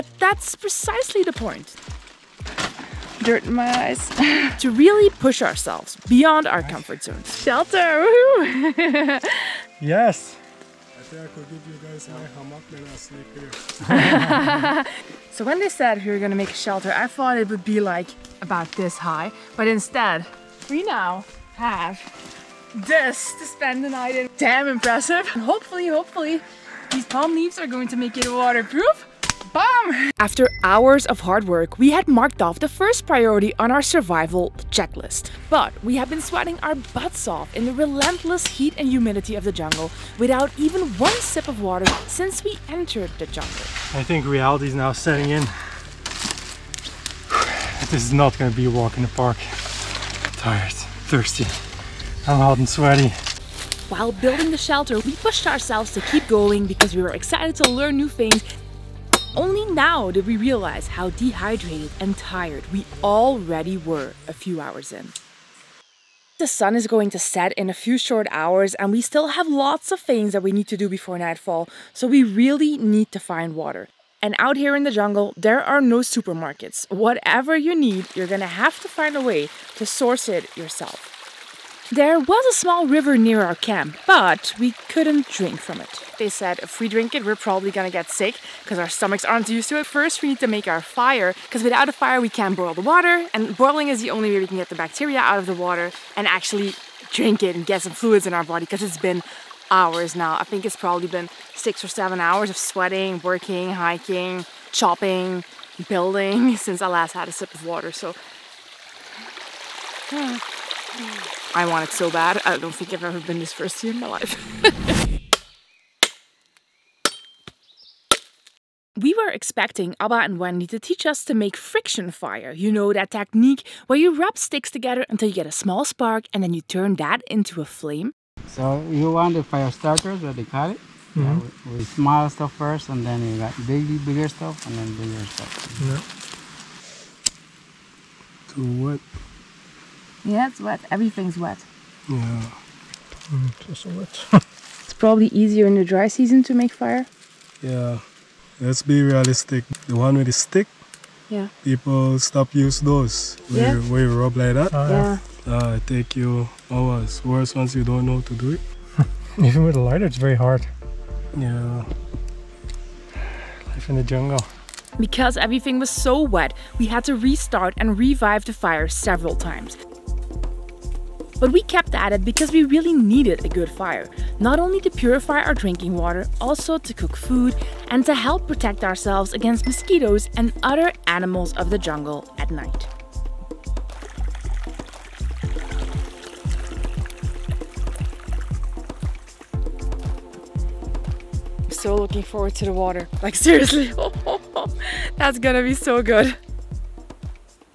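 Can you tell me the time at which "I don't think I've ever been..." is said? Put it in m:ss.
1:52.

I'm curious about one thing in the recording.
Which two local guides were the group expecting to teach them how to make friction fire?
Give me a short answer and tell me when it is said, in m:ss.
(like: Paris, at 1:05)
Abba and Wendy, at 1:59.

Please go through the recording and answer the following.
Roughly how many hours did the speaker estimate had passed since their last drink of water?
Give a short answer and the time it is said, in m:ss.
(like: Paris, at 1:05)
6 or 7, at 1:41.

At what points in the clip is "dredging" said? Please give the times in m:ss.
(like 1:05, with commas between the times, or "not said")
not said.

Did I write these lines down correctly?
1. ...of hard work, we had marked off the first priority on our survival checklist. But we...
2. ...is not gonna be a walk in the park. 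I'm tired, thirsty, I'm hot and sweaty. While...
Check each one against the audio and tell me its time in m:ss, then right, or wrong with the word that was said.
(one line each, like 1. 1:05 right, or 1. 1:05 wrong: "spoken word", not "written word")
1. 0:31 right
2. 0:48 right.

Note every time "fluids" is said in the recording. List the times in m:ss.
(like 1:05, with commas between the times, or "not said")
1:37.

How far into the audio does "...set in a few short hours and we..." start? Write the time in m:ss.
1:07.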